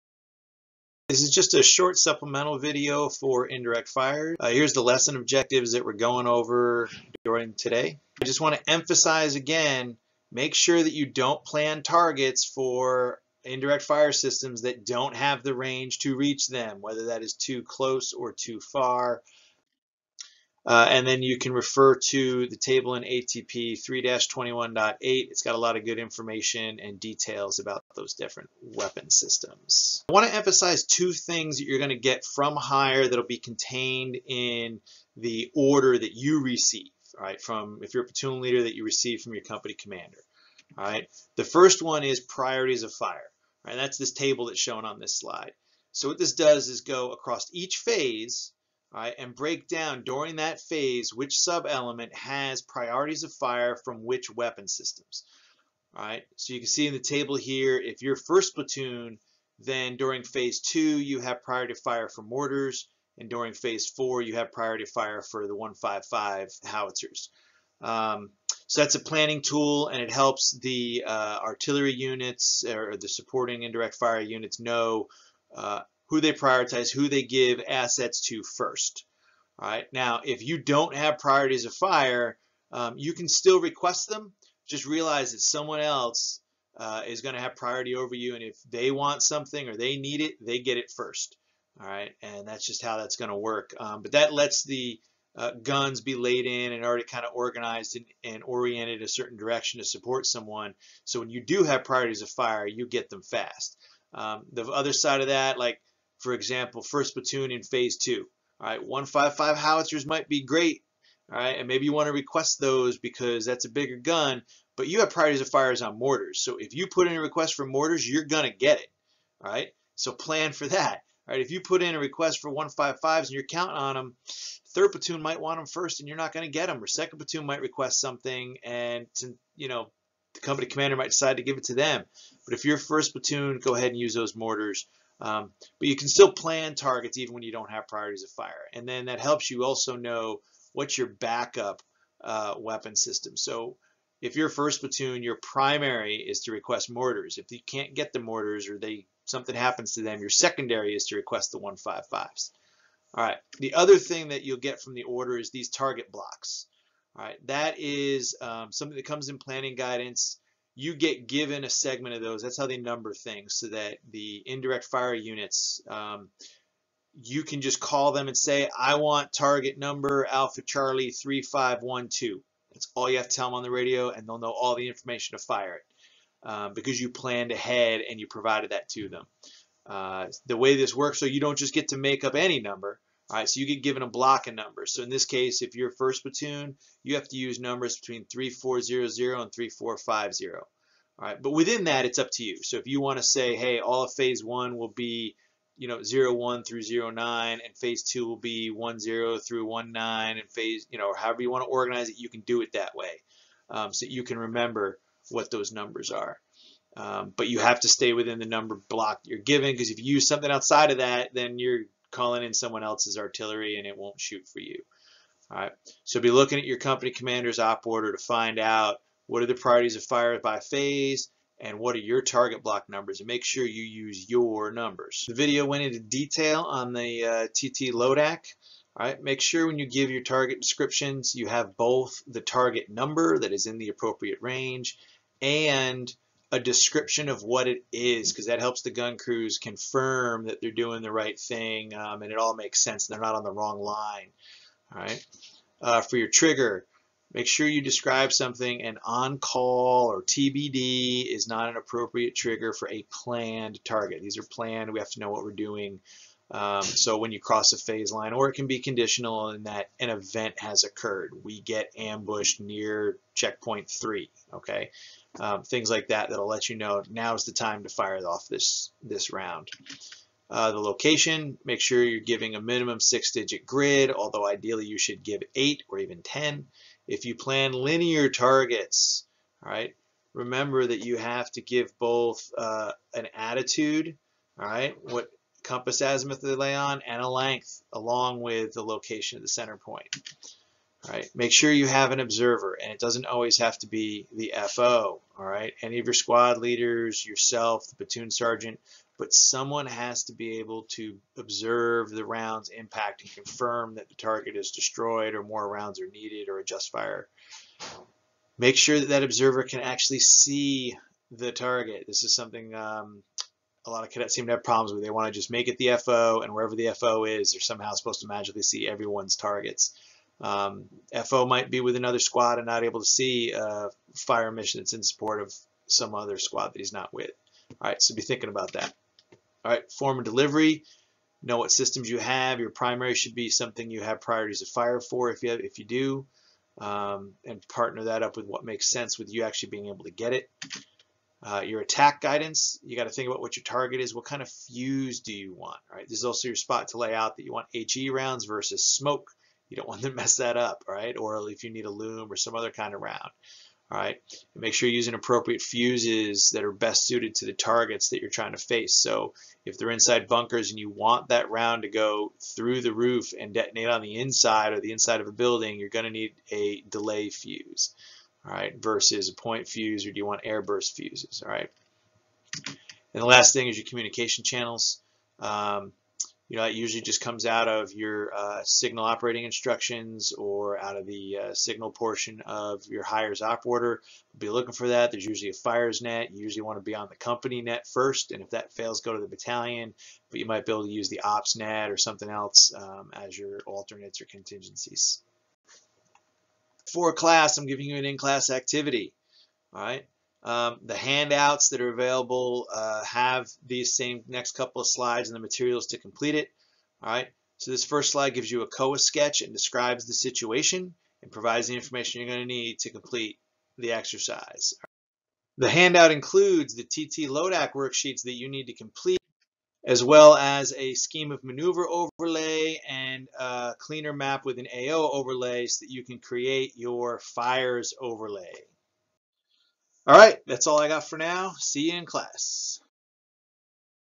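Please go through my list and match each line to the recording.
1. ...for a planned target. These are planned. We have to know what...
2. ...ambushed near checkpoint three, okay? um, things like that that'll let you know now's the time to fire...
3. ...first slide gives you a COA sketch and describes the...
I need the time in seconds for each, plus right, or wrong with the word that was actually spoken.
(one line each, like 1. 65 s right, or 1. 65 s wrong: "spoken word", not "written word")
1. 252 s right
2. 261 s right
3. 407 s right.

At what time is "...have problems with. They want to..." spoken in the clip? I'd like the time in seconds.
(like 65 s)
314 s.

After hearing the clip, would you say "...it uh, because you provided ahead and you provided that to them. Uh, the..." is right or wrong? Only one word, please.
wrong.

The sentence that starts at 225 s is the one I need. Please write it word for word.
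The video went into detail on the uh, TT LODAC.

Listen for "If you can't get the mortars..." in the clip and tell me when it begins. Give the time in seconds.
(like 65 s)
147 s.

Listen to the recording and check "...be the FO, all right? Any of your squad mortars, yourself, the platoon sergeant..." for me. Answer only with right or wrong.
wrong.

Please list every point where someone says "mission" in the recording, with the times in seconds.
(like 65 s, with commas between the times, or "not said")
324 s.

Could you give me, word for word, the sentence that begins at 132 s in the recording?
But if you're 1st Platoon, go ahead and use those mortars.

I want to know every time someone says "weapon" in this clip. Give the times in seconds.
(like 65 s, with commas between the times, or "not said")
28 s, 54 s, 142 s.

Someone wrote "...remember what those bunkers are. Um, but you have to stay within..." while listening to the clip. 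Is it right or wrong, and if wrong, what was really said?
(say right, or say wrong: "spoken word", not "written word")
wrong: "numbers", not "bunkers".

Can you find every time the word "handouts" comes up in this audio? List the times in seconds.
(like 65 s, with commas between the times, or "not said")
400 s, 415 s.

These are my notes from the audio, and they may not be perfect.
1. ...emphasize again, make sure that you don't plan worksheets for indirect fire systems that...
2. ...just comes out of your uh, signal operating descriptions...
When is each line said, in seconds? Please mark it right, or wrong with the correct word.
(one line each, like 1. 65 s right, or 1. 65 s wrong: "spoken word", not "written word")
1. 8 s wrong: "targets", not "worksheets"
2. 377 s wrong: "instructions", not "descriptions".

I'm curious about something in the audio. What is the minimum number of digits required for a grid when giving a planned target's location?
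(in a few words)
6.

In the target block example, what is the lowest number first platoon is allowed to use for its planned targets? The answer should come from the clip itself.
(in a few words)
3400.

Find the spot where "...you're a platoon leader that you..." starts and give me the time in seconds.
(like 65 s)
37 s.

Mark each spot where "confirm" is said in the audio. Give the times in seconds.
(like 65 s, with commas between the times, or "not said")
239 s, 303 s.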